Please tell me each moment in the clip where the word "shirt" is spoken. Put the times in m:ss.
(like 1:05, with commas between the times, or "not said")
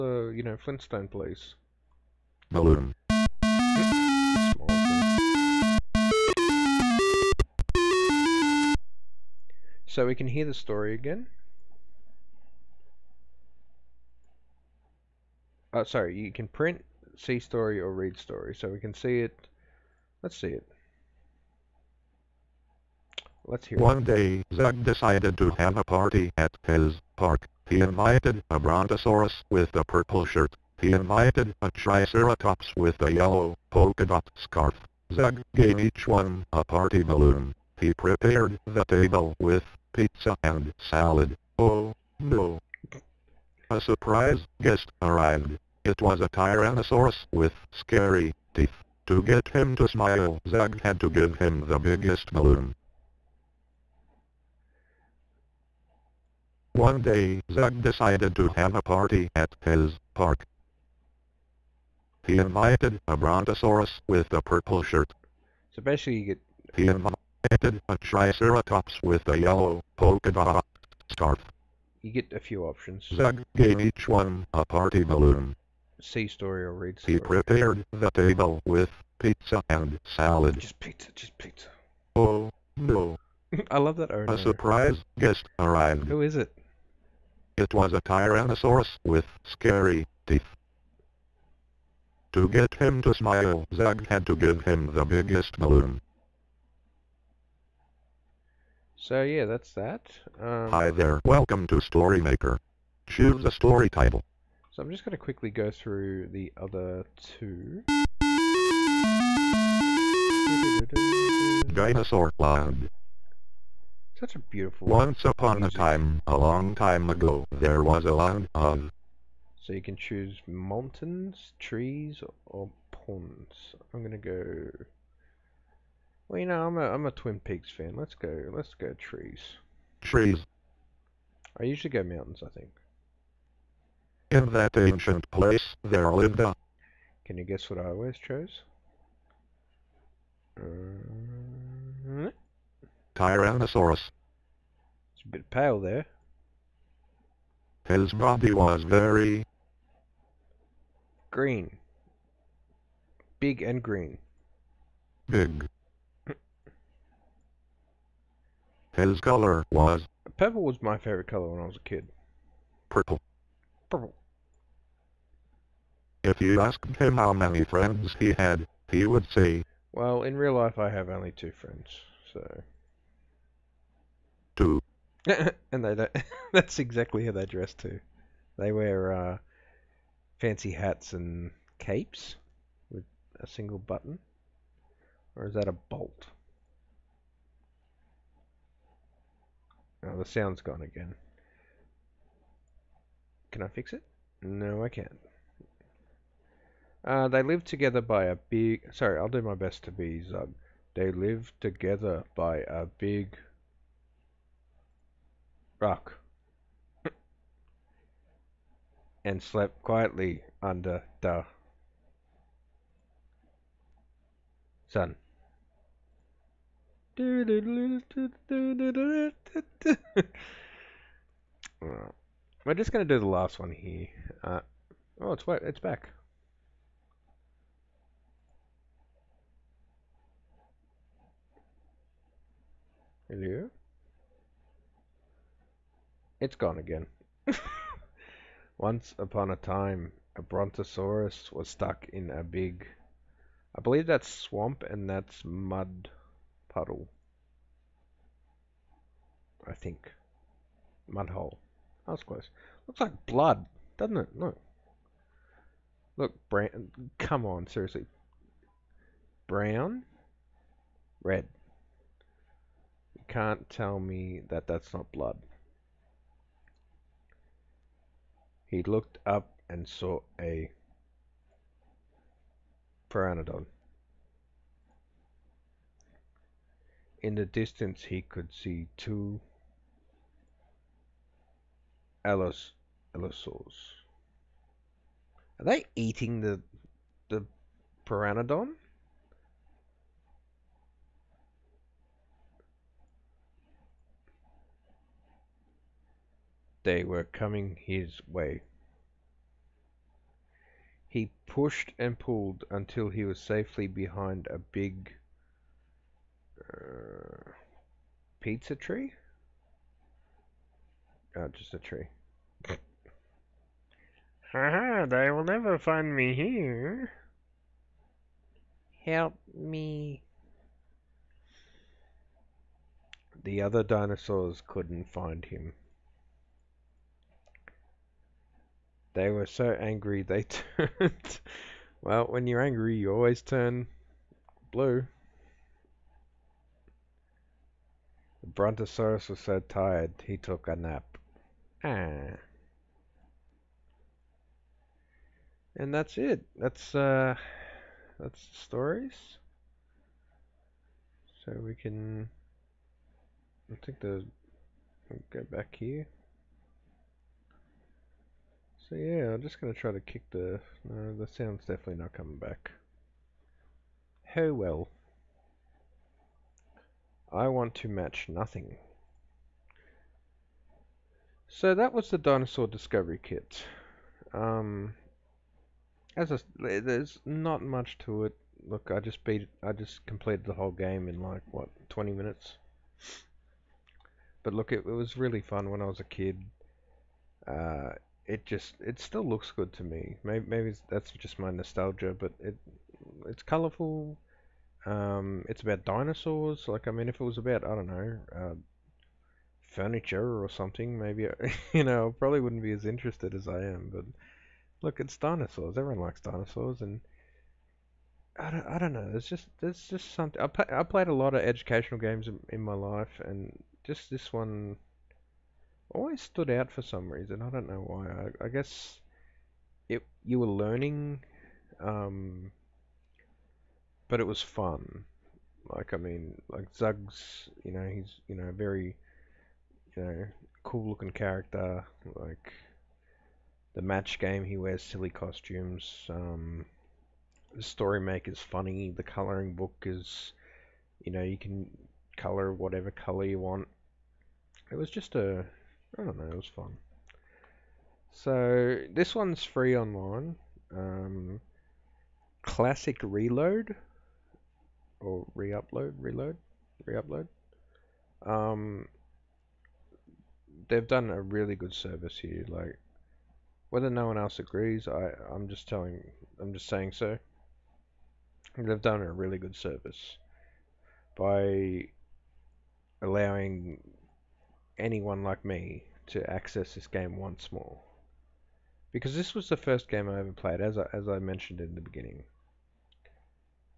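0:30, 1:04.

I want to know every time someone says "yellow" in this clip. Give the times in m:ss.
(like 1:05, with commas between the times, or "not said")
0:33, 1:09.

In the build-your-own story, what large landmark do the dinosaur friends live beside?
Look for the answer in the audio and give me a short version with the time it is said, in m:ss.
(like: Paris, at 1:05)
big rock, at 3:22.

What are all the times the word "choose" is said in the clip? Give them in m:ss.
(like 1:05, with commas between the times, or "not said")
1:43, 1:59.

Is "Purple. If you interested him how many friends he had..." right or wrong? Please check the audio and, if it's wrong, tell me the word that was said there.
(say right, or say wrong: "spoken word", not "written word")
wrong: "asked", not "interested".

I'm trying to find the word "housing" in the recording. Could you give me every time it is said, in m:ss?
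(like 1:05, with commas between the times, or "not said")
not said.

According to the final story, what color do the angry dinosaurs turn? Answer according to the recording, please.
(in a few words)
blue.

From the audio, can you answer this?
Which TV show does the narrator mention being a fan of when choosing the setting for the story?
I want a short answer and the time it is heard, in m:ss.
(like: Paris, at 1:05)
Twin Peaks, at 2:07.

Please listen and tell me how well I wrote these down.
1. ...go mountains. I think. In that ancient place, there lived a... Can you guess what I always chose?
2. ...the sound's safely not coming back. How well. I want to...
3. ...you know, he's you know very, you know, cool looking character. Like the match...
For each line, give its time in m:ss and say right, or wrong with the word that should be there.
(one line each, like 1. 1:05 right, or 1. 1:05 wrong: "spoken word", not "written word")
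1. 2:11 right
2. 6:01 wrong: "definitely", not "safely"
3. 7:07 right.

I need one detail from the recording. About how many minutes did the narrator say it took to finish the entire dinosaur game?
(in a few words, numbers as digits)
20.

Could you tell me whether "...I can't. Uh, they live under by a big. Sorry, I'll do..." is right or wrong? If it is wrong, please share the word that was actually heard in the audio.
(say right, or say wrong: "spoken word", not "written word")
wrong: "together", not "under".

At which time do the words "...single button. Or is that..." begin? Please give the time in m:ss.
3:03.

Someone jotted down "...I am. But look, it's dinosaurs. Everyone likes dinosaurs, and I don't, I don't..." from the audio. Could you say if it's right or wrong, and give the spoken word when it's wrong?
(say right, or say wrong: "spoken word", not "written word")
right.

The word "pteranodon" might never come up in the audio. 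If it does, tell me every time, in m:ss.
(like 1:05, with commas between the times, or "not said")
4:33, 4:48.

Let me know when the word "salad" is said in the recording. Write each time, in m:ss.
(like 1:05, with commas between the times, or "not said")
0:40, 1:20.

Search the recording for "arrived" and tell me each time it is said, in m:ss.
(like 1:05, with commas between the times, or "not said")
0:45, 1:25.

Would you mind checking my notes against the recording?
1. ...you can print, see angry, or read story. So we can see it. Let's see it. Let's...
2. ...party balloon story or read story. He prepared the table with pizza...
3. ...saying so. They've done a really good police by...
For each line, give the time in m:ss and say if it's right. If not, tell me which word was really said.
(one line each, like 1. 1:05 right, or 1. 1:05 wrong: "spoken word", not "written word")
1. 0:16 wrong: "story", not "angry"
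2. 1:14 right
3. 7:46 wrong: "service", not "police".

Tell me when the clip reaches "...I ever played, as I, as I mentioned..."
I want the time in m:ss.
8:00.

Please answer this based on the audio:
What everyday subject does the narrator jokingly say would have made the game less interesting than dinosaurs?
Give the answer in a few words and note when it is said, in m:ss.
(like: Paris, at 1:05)
furniture, at 6:39.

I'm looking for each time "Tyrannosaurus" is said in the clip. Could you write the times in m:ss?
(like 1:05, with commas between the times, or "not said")
0:46, 1:28, 2:23.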